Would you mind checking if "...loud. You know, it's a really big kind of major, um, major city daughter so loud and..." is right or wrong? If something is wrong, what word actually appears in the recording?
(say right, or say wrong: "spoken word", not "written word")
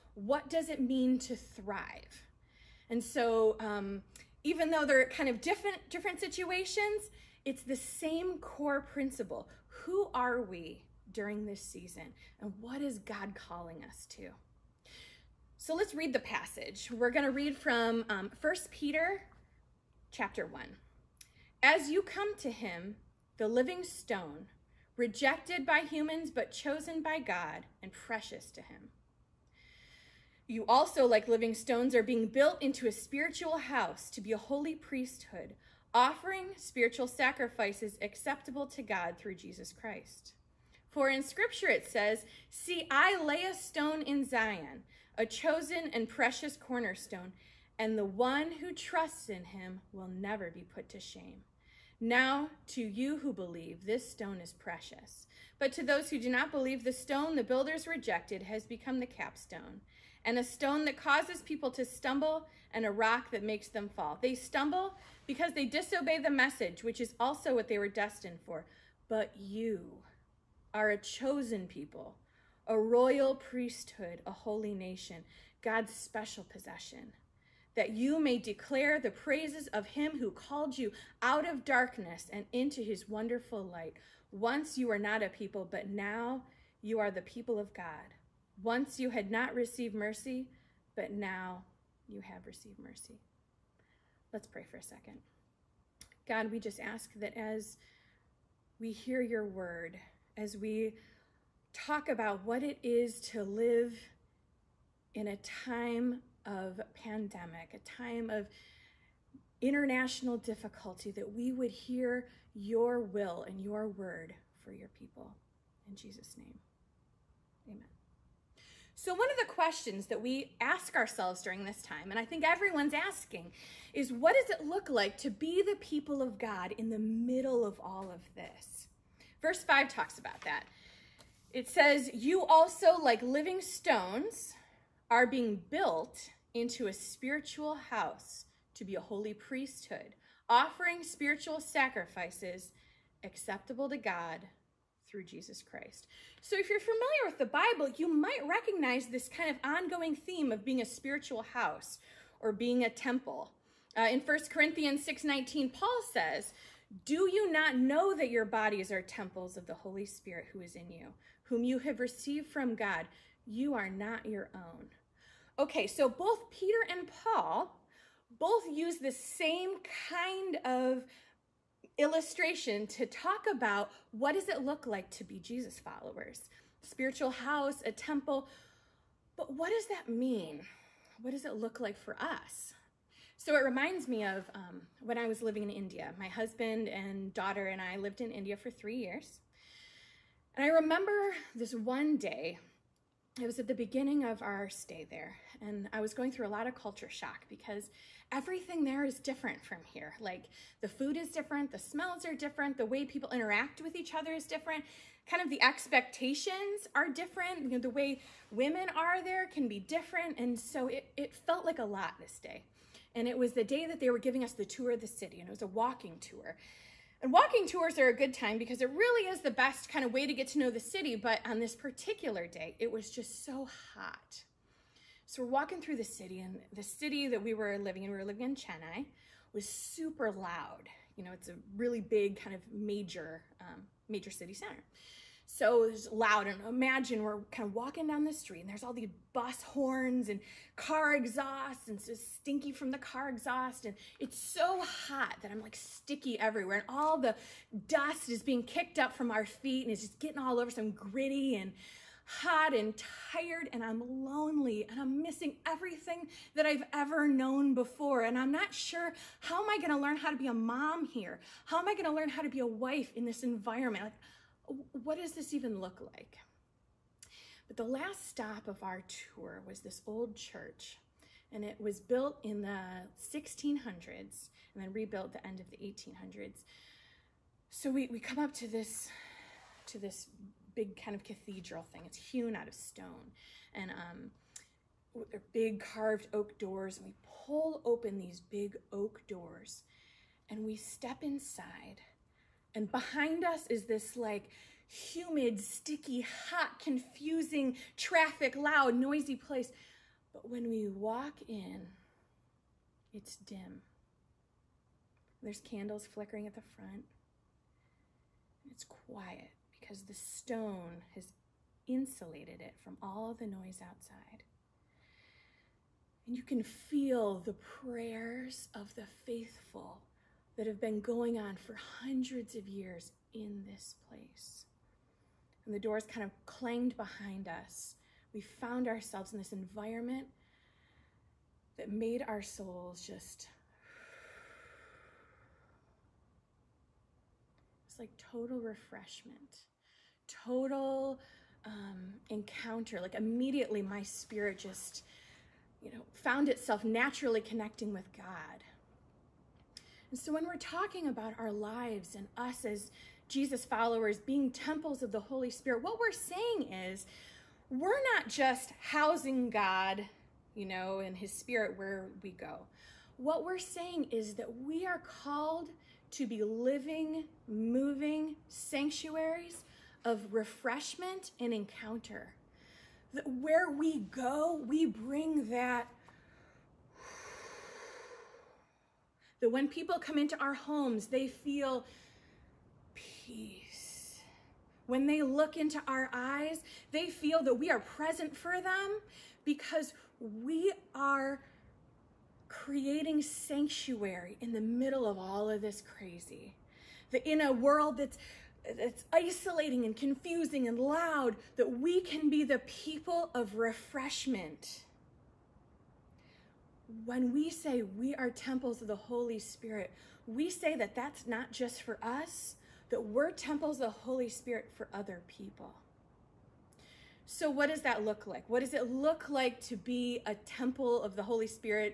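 wrong: "center", not "daughter".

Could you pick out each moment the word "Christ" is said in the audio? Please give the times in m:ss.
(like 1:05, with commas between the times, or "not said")
0:39, 2:25.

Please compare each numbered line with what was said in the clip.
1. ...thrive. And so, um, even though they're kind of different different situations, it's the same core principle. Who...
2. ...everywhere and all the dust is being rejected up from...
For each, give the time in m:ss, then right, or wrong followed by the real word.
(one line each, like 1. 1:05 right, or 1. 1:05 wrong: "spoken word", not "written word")
1. 0:01 right
2. 4:06 wrong: "kicked", not "rejected".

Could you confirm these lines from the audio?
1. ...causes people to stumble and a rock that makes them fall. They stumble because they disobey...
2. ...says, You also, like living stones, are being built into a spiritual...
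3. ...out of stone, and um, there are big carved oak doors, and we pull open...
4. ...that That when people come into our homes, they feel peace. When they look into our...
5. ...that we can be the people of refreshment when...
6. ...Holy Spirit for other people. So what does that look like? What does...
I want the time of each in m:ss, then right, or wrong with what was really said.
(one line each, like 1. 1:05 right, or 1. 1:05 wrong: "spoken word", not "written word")
1. 1:00 right
2. 2:11 right
3. 4:42 right
4. 6:15 right
5. 6:41 right
6. 6:53 right.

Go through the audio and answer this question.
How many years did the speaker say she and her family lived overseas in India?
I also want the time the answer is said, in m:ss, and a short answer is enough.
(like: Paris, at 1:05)
3 years, at 3:08.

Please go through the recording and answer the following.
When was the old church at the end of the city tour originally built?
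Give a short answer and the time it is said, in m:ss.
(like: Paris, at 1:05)
1600s, at 4:33.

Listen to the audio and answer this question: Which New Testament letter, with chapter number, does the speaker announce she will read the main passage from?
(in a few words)
1 Peter chapter 1.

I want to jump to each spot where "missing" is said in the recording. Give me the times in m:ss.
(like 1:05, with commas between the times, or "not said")
4:15.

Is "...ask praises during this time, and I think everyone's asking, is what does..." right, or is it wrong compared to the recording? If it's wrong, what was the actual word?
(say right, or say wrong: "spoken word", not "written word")
wrong: "ourselves", not "praises".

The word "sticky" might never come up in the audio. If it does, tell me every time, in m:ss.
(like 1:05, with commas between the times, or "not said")
4:05, 4:55.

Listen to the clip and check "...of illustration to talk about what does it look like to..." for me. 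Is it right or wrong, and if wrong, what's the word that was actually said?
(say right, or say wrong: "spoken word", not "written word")
right.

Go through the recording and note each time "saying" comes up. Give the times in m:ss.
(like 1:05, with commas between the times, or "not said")
5:56, 6:03.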